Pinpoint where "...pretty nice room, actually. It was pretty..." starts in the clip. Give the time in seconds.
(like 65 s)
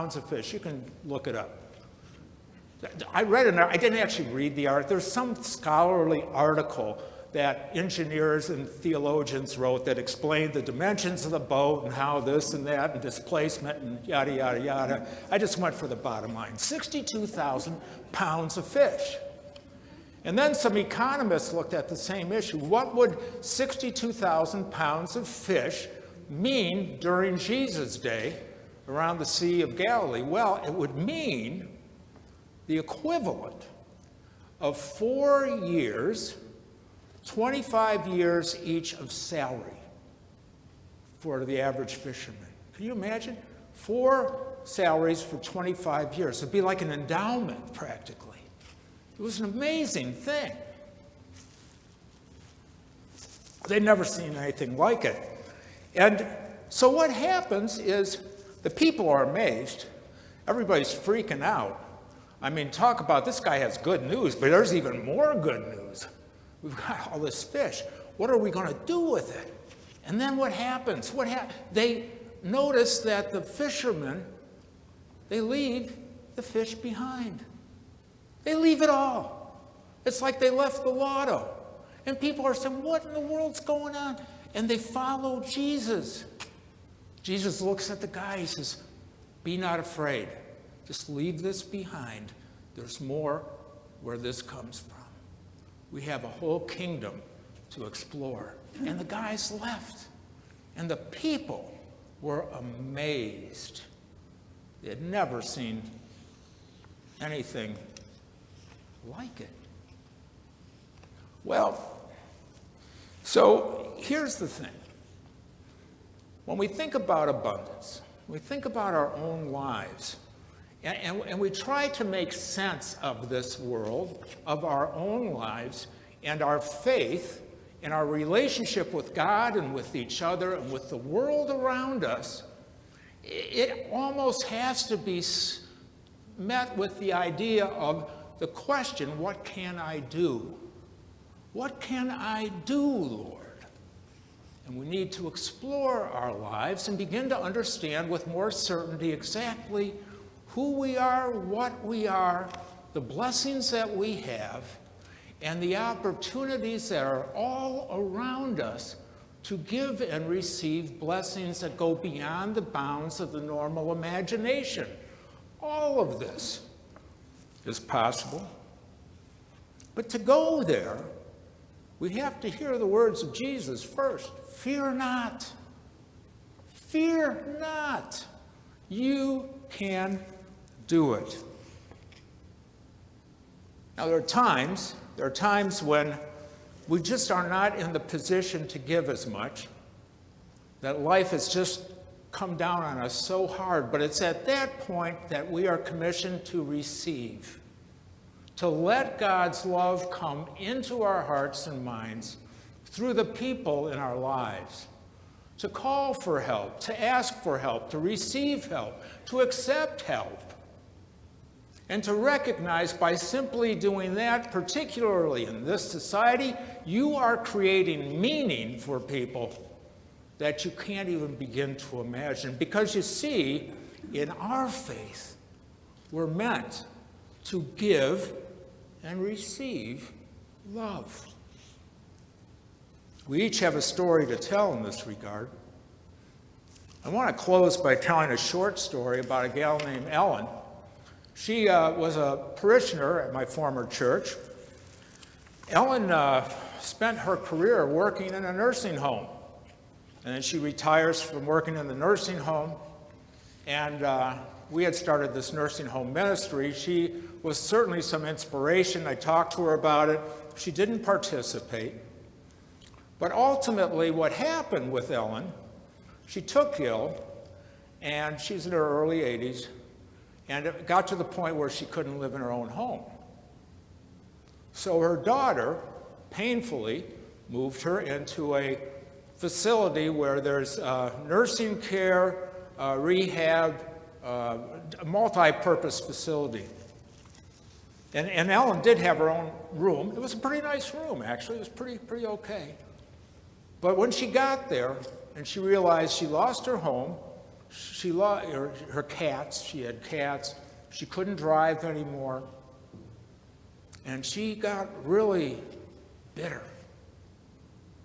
290 s.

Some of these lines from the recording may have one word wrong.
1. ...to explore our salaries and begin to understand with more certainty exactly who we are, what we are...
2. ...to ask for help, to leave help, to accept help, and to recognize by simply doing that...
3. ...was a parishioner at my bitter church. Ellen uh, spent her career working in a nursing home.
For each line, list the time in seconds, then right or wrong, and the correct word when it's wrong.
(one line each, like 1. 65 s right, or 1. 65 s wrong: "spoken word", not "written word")
1. 145 s wrong: "lives", not "salaries"
2. 206 s wrong: "receive", not "leave"
3. 241 s wrong: "former", not "bitter".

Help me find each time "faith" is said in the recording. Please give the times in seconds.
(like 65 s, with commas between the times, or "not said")
126 s, 224 s.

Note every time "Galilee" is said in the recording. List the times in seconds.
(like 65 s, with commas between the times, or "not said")
29 s.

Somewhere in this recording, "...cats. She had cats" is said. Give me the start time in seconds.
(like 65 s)
299 s.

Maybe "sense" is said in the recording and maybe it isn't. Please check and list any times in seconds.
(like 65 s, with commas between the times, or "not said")
122 s.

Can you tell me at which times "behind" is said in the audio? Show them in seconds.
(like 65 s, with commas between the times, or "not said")
76 s, 91 s.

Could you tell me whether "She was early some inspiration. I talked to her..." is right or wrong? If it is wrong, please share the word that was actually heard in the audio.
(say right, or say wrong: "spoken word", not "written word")
wrong: "certainly", not "early".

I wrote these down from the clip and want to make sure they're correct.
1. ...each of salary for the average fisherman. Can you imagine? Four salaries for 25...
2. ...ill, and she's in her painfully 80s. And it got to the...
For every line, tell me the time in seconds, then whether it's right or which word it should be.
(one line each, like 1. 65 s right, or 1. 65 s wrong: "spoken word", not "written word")
1. 38 s right
2. 266 s wrong: "early", not "painfully".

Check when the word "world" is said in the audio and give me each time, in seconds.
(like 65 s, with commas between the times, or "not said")
83 s, 123 s, 130 s.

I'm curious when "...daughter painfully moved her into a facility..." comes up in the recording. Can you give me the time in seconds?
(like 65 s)
275 s.